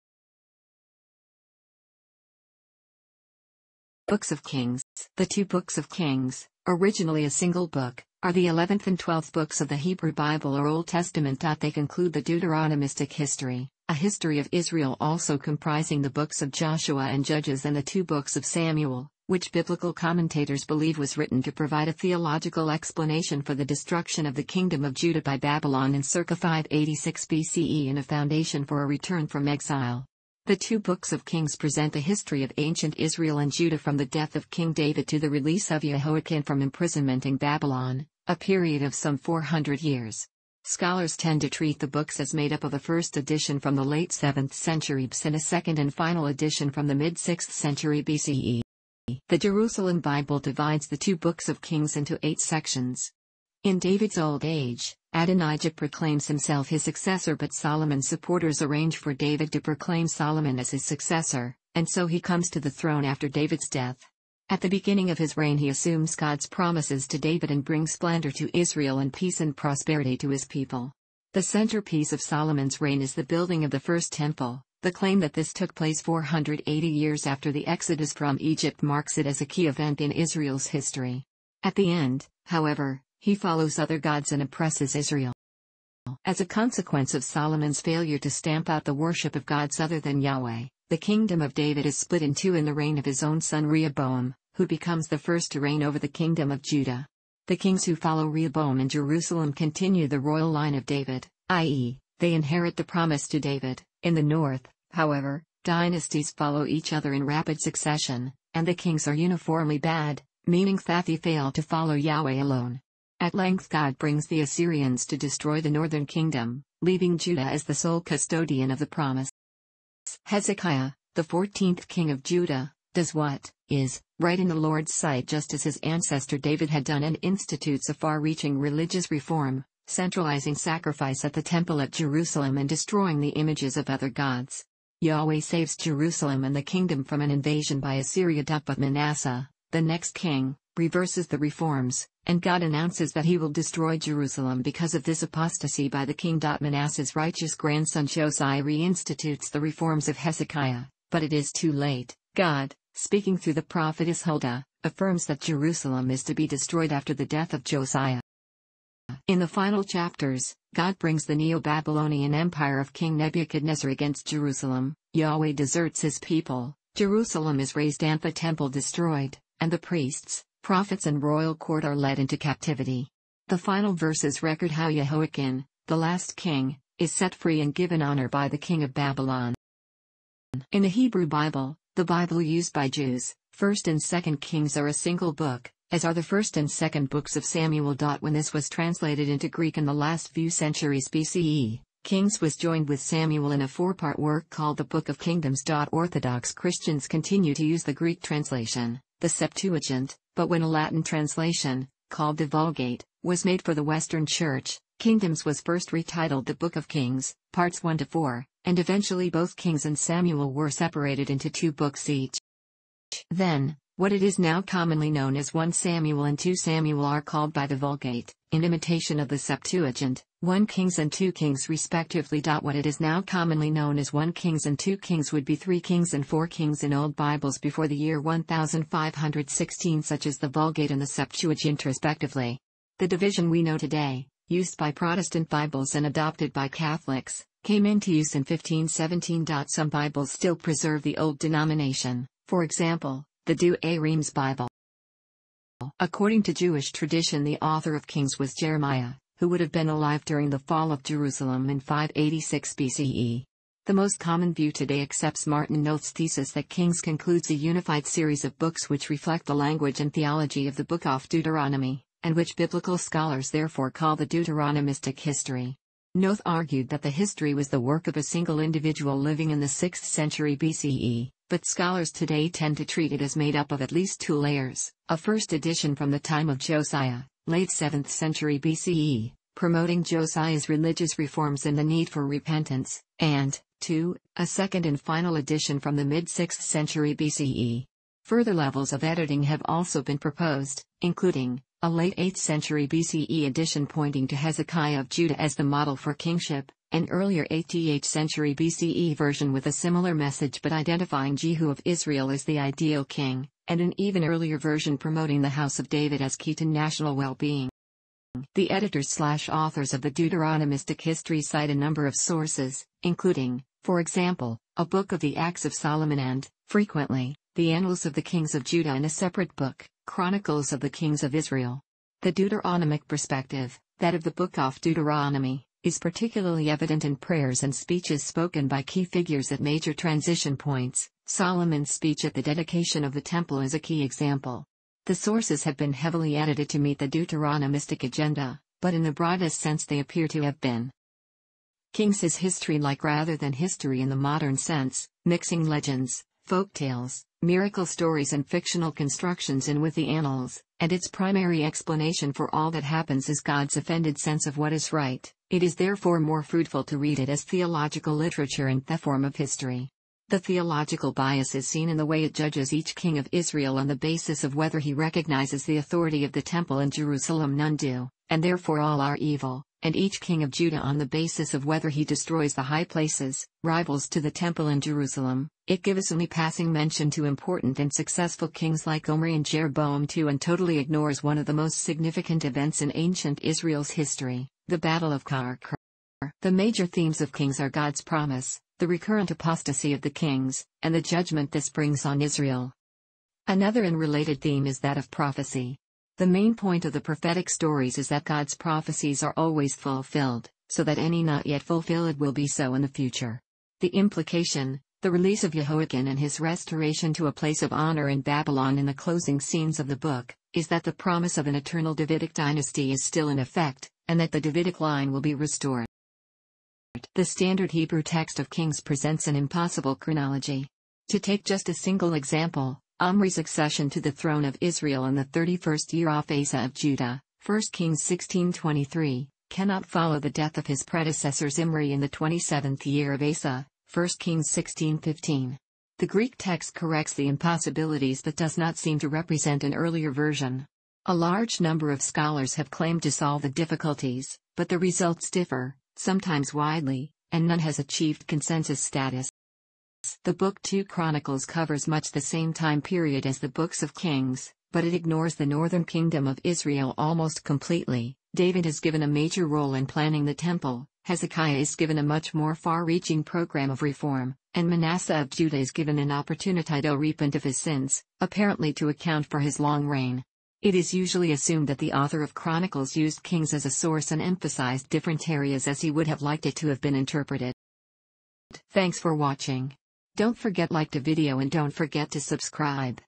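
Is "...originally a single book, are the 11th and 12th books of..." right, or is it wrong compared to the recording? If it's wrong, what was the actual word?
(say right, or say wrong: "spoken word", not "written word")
right.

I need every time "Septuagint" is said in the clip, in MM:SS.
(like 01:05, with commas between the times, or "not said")
03:19, 03:39, 03:51.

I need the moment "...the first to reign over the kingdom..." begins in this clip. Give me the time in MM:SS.
01:35.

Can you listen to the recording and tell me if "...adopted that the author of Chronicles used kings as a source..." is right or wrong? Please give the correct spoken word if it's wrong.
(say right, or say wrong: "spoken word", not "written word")
wrong: "assumed", not "adopted".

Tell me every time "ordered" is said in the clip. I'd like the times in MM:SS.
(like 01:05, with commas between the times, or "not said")
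not said.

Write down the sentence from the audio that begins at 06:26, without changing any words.
The major themes of Kings are God's promise, the recurrent apostasy of the kings, and the judgment this brings on Israel.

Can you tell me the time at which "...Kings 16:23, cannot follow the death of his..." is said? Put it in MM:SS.
07:07.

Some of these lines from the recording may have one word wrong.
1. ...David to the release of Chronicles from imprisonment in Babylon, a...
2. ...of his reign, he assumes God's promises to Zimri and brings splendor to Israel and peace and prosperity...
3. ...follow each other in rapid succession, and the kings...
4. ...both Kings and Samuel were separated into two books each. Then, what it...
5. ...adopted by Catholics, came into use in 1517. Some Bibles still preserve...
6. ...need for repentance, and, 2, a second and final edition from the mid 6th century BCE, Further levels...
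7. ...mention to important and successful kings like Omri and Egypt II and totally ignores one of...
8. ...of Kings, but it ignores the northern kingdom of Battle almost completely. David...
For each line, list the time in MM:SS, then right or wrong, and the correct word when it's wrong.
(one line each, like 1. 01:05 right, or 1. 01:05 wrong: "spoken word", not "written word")
1. 00:34 wrong: "Jehoiachin", not "Chronicles"
2. 01:05 wrong: "David", not "Zimri"
3. 01:46 right
4. 03:29 right
5. 03:56 right
6. 04:41 right
7. 06:16 wrong: "Jeroboam", not "Egypt"
8. 07:33 wrong: "Israel", not "Battle".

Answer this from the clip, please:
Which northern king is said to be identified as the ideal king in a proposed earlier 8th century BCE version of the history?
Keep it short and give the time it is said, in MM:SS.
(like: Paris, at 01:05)
Jehu, at 05:01.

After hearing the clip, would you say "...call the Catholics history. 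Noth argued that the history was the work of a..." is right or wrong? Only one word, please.
wrong.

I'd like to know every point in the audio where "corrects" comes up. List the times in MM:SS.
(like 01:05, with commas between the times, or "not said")
07:16.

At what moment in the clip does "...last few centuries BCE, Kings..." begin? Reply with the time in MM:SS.
03:09.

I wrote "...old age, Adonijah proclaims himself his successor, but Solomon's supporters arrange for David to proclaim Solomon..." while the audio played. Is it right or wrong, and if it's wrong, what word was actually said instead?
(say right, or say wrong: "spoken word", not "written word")
right.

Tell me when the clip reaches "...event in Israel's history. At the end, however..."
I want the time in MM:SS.
01:19.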